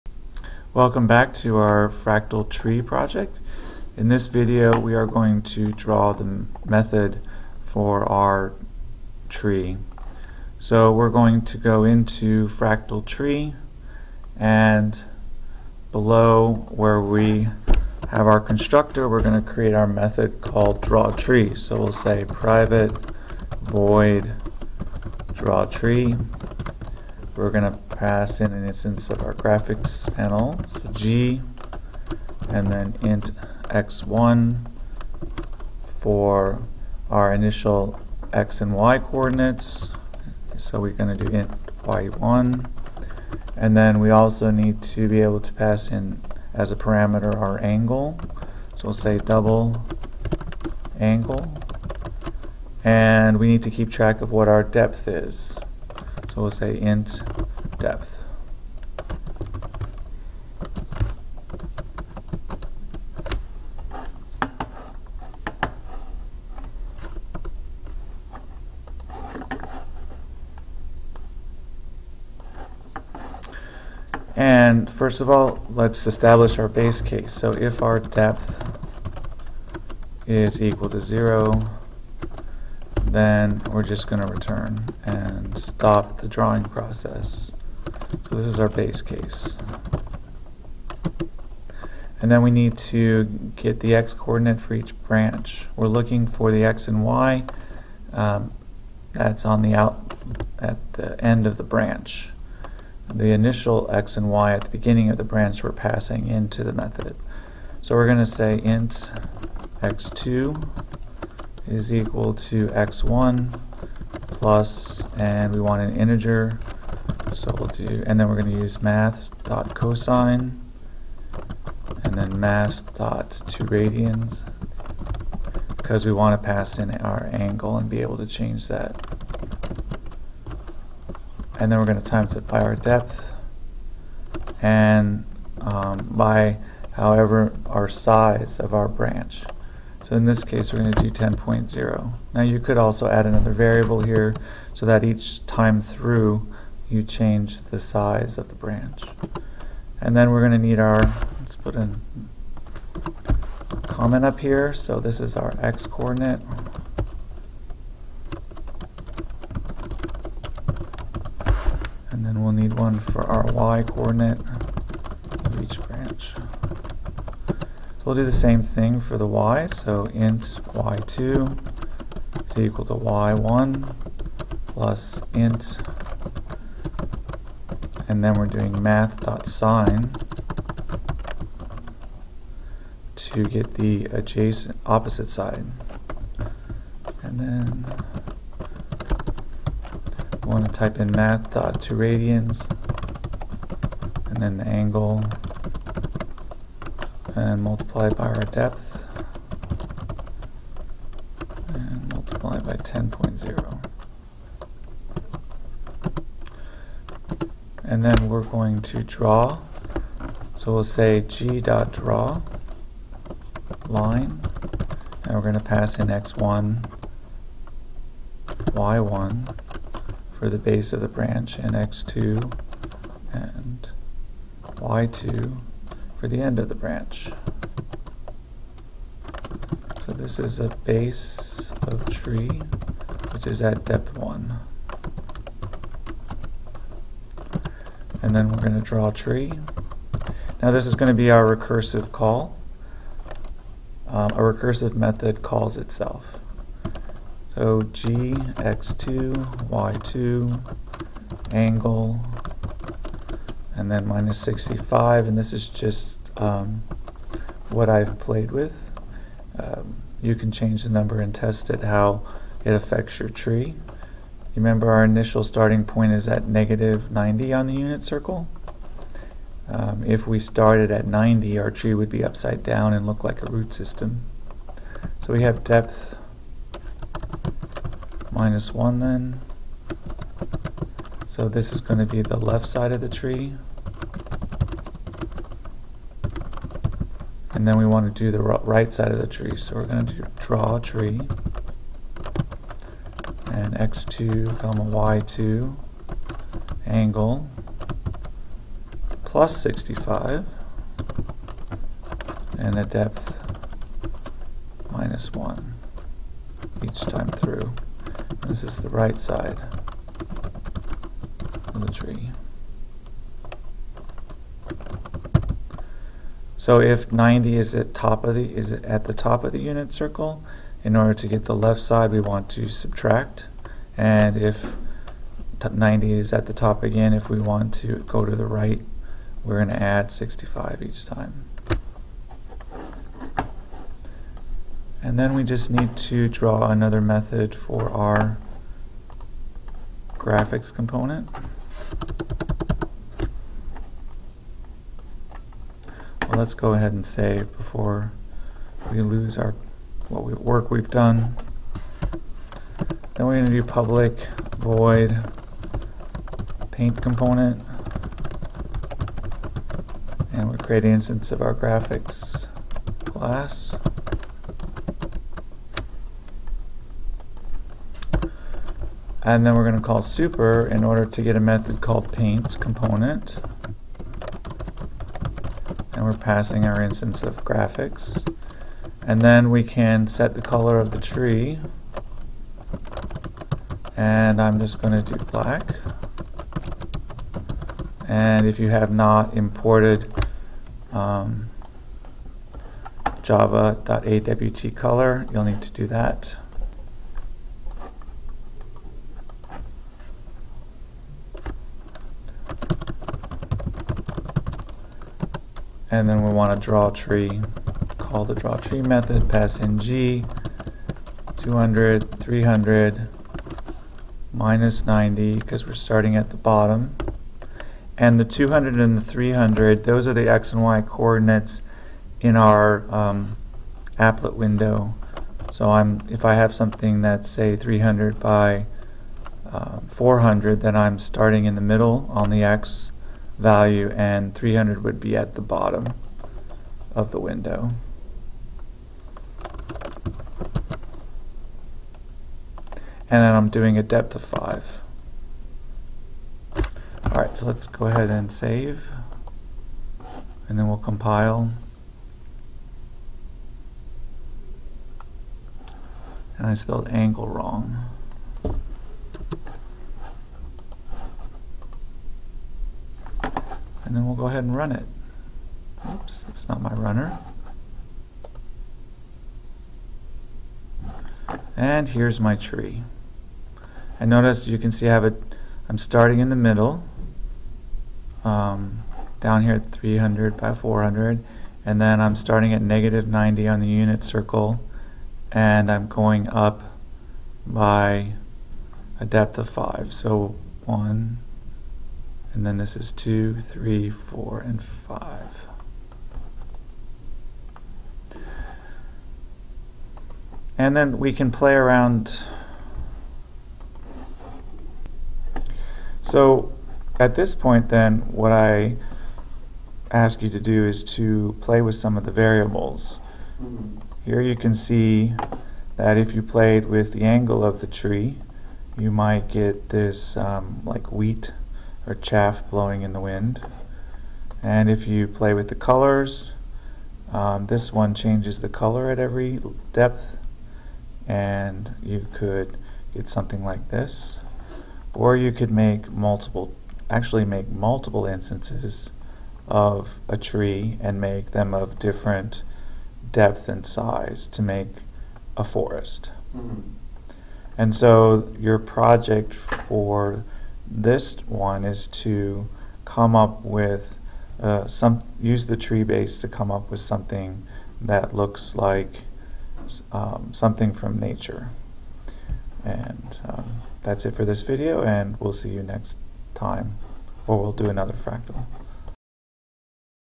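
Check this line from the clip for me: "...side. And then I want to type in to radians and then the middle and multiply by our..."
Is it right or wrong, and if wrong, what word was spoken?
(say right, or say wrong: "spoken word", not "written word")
wrong: "angle", not "middle".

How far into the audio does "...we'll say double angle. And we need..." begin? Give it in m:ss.
0:48.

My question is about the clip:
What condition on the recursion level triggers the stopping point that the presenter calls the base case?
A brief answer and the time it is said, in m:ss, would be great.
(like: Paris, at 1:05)
depth equal to 0, at 1:17.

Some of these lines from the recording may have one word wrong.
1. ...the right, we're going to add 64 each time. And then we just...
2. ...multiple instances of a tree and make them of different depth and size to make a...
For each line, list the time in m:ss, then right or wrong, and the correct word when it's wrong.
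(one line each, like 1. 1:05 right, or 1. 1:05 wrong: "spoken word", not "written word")
1. 5:28 wrong: "65", not "64"
2. 8:57 right.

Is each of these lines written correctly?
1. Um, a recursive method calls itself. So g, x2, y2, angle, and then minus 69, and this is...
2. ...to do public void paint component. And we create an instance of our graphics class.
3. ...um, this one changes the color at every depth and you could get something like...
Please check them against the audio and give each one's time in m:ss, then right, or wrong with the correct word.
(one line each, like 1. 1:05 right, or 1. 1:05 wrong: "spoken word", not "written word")
1. 4:04 wrong: "65", not "69"
2. 5:53 right
3. 8:47 right.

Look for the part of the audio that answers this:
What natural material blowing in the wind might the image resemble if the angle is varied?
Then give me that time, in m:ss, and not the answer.
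8:40.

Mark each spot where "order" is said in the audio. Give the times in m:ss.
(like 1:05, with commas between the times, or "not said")
5:20, 6:10.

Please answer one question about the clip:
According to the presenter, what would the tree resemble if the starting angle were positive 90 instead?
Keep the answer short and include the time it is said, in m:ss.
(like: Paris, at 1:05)
a root system, at 4:33.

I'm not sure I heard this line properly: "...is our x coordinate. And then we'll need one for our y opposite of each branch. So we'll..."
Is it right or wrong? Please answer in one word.
wrong.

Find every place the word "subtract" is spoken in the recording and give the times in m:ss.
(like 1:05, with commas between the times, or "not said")
5:22.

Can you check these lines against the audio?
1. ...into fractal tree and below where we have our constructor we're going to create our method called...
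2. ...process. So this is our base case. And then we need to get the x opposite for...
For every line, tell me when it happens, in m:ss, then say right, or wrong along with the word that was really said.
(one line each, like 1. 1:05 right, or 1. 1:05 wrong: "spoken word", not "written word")
1. 0:11 right
2. 1:26 wrong: "coordinate", not "opposite".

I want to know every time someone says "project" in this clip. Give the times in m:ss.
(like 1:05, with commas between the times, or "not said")
0:02, 9:08.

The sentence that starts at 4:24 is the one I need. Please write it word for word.
Remember our initial starting point is at negative 90 on the unit circle.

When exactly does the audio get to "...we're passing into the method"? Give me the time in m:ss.
1:45.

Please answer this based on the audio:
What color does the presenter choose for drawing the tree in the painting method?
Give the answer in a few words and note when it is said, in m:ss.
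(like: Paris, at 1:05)
black, at 6:25.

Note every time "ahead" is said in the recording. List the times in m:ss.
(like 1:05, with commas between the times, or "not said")
5:46, 7:27, 7:44.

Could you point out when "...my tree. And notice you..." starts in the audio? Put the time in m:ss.
7:52.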